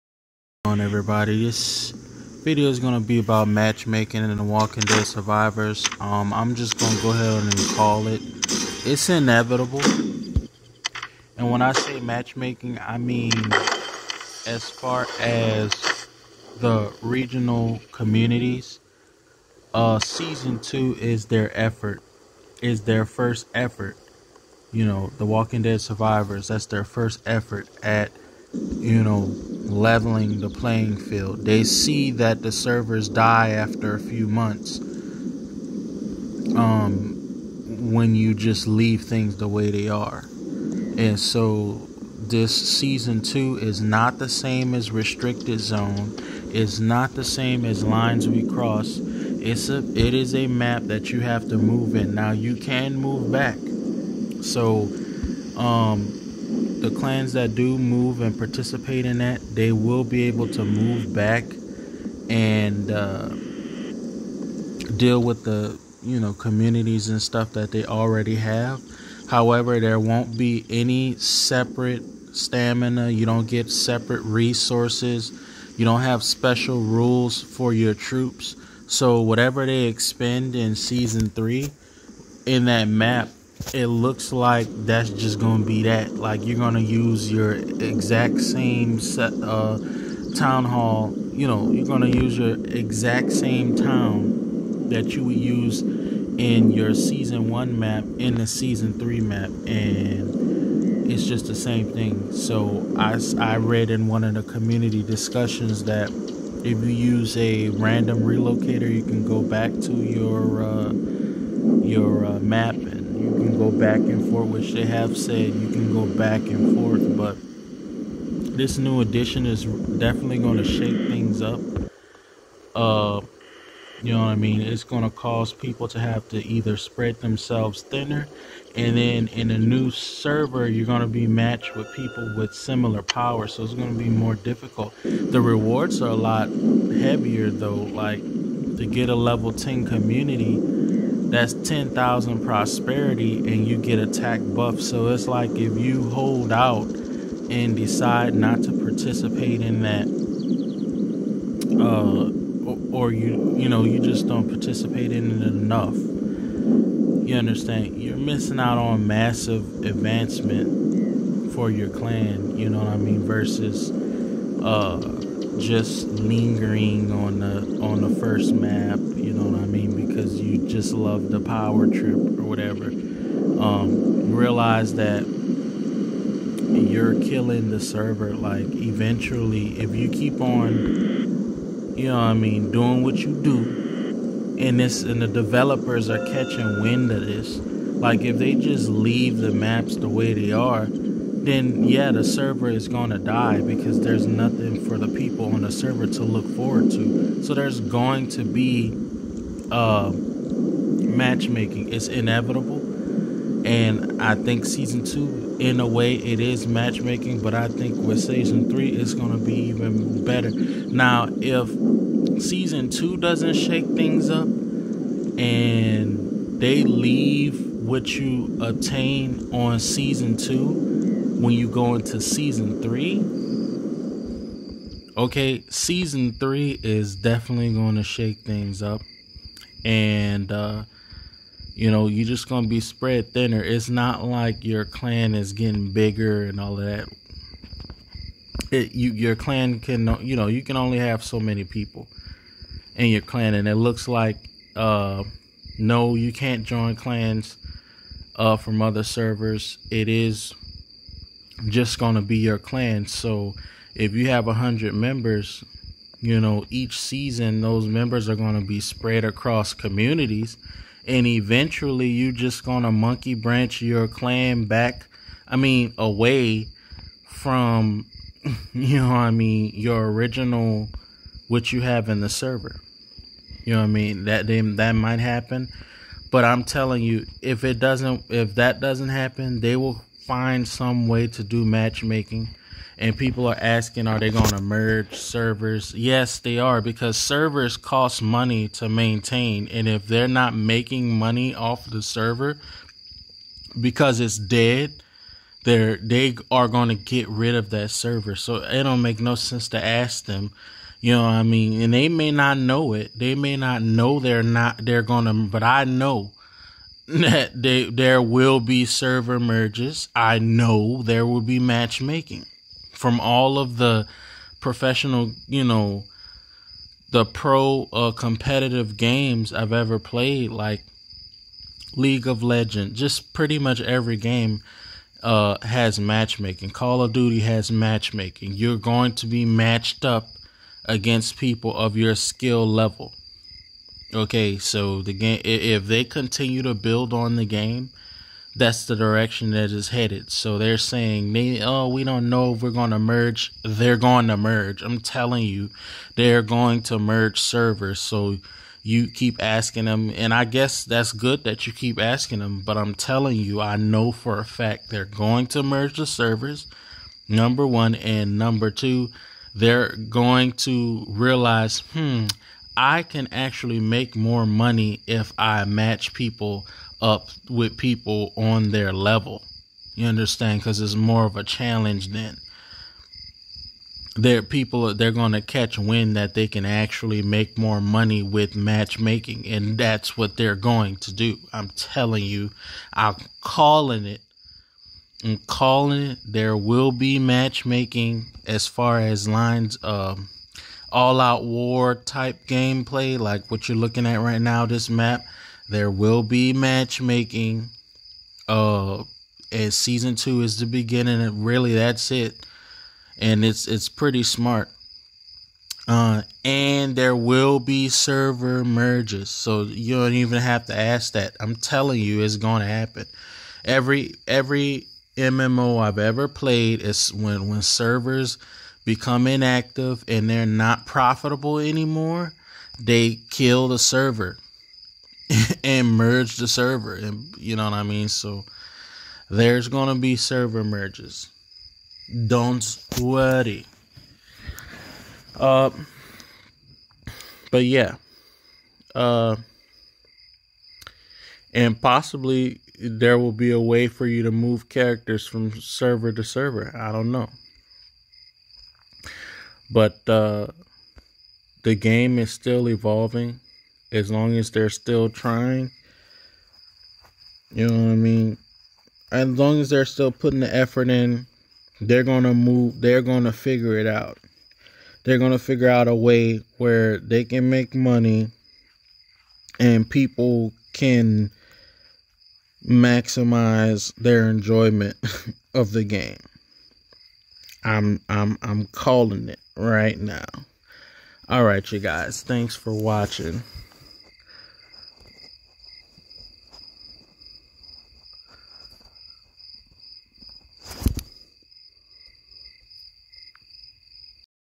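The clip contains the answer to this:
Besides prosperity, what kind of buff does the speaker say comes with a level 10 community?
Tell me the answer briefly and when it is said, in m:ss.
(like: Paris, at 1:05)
Attack buff, at 2:23.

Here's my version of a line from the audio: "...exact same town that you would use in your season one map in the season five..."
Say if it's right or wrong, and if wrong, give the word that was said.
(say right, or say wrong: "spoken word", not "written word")
wrong: "three", not "five".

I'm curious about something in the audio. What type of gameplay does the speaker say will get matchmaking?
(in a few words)
All out war.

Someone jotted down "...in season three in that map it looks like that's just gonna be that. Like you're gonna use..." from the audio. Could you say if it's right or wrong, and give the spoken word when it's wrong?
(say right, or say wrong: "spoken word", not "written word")
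right.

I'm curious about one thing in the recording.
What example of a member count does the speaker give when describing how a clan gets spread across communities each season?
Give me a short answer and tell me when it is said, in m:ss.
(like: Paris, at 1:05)
100, at 4:14.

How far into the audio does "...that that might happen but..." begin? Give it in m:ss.
4:34.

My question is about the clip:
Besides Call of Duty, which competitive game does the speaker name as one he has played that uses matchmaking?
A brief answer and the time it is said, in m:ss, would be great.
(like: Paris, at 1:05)
League of Legends, at 5:21.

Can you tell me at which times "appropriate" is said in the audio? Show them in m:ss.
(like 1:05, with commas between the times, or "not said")
not said.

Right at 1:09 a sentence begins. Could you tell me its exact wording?
However, there won't be any separate stamina.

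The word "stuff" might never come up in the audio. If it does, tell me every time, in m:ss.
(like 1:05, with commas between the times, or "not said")
1:07.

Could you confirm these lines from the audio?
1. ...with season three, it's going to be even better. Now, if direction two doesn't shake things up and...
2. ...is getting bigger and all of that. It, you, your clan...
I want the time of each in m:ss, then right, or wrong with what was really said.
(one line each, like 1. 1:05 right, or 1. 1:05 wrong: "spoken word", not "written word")
1. 3:27 wrong: "season", not "direction"
2. 3:55 right.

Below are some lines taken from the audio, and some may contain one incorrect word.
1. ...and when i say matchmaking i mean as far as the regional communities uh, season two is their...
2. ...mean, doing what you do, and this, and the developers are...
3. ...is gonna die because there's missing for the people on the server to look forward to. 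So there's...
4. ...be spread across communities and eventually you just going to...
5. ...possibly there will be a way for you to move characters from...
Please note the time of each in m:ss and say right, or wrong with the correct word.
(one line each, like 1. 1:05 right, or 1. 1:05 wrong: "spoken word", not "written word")
1. 0:11 right
2. 3:02 right
3. 3:12 wrong: "nothing", not "missing"
4. 4:18 right
5. 7:21 right.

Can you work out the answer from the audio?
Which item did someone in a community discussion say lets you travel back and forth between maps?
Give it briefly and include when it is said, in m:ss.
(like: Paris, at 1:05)
Random relocator, at 1:47.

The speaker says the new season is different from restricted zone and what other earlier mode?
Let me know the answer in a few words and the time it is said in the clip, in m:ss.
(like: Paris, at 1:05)
Lines We Cross, at 0:47.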